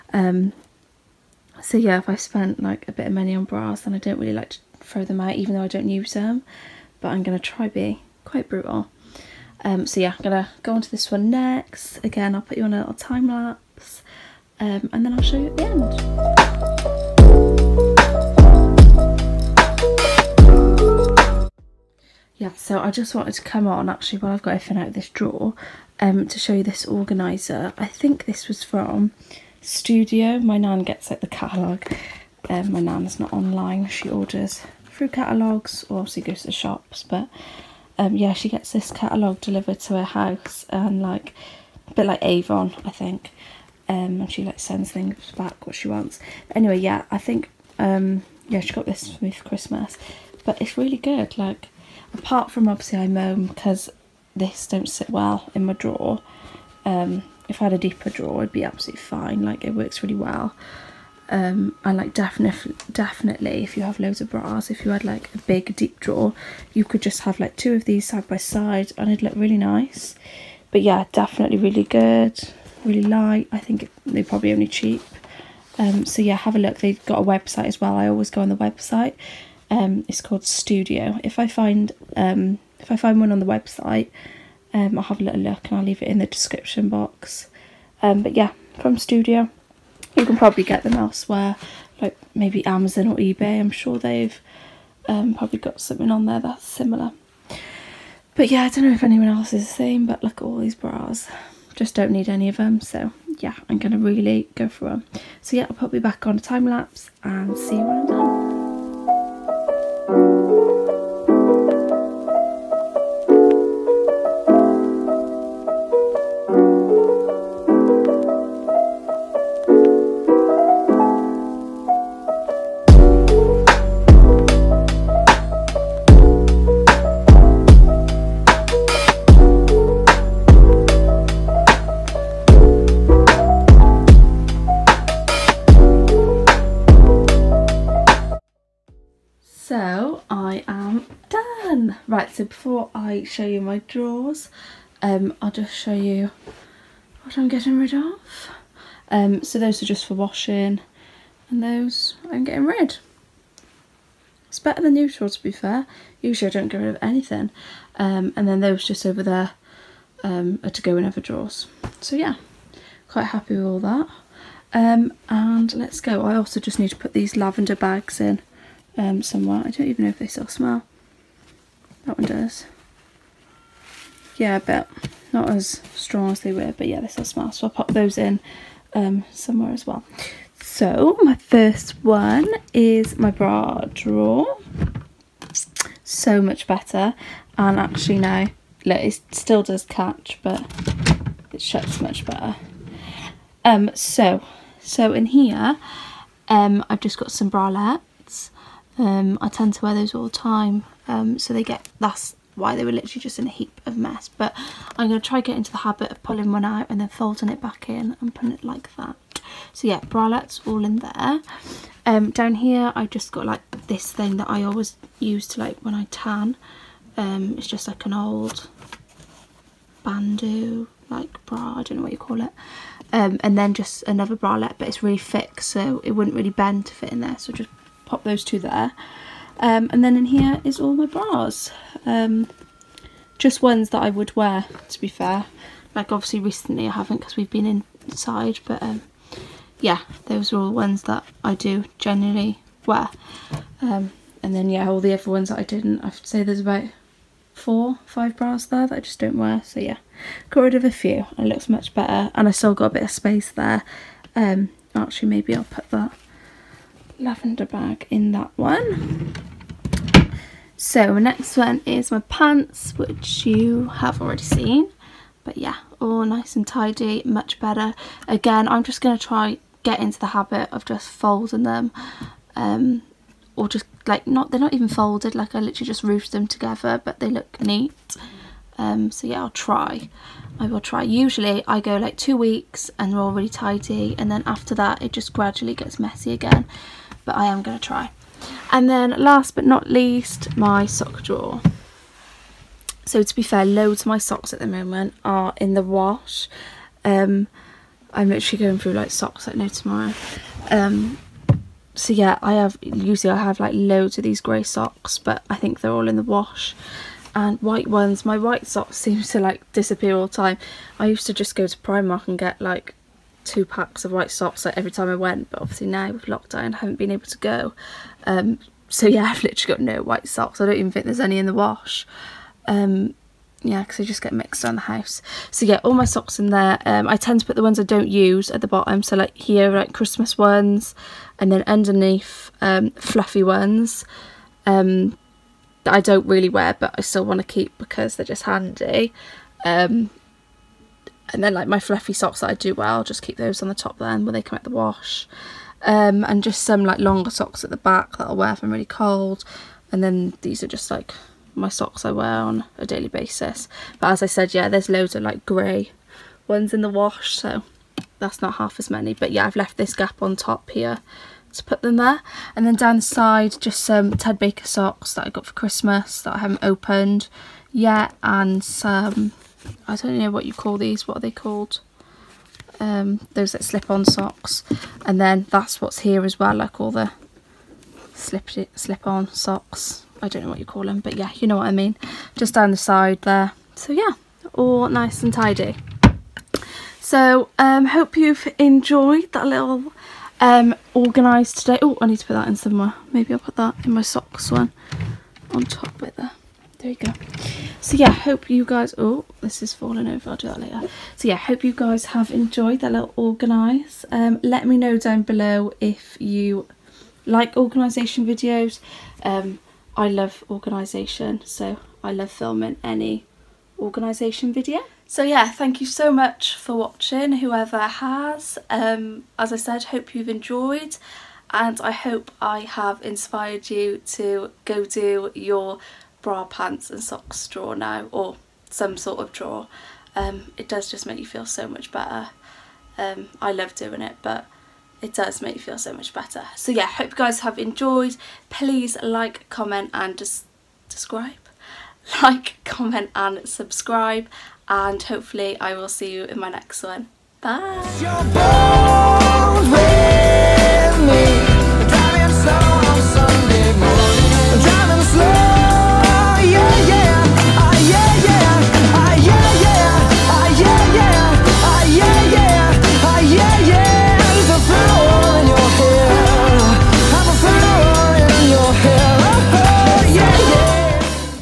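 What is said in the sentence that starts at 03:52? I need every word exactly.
Um, just ones that I would wear, to be fair.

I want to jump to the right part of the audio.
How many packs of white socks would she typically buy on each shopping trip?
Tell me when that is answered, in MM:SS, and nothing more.
05:13.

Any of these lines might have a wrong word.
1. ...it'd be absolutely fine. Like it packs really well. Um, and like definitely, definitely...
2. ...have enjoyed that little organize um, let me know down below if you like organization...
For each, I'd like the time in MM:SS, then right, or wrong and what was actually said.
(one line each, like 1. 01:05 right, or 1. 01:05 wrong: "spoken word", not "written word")
1. 00:58 wrong: "works", not "packs"
2. 06:42 right.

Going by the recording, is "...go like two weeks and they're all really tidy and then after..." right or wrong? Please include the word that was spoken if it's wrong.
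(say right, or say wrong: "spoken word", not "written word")
right.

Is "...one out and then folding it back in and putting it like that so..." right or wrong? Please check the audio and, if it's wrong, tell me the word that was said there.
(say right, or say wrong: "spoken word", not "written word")
right.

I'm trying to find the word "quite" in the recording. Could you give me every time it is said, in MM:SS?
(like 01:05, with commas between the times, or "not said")
00:08, 02:43.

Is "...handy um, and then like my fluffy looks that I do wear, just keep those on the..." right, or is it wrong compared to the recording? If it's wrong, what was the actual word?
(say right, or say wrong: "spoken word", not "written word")
wrong: "socks", not "looks".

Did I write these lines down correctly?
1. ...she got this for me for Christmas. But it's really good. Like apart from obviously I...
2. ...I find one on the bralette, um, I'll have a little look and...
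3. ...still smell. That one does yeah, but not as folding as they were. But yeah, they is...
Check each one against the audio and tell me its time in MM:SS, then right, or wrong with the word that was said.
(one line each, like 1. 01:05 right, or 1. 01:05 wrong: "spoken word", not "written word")
1. 00:48 right
2. 01:22 wrong: "website", not "bralette"
3. 02:50 wrong: "strong", not "folding".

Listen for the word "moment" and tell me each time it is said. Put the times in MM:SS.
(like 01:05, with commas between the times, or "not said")
04:54.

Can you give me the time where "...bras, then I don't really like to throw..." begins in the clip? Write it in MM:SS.
00:03.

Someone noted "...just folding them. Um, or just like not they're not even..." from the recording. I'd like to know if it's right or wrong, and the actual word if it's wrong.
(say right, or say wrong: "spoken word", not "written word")
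right.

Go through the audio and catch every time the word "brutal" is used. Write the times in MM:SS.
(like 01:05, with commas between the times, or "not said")
00:08.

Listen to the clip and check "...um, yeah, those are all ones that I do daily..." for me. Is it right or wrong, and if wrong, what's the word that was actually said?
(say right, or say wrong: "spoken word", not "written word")
wrong: "generally", not "daily".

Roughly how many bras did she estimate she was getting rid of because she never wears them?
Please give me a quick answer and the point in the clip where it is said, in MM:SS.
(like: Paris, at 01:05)
4 or 5, at 04:07.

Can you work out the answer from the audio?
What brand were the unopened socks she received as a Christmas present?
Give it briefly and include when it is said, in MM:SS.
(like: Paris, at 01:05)
Ted Baker, at 06:04.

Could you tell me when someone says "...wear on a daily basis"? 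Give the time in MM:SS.
05:52.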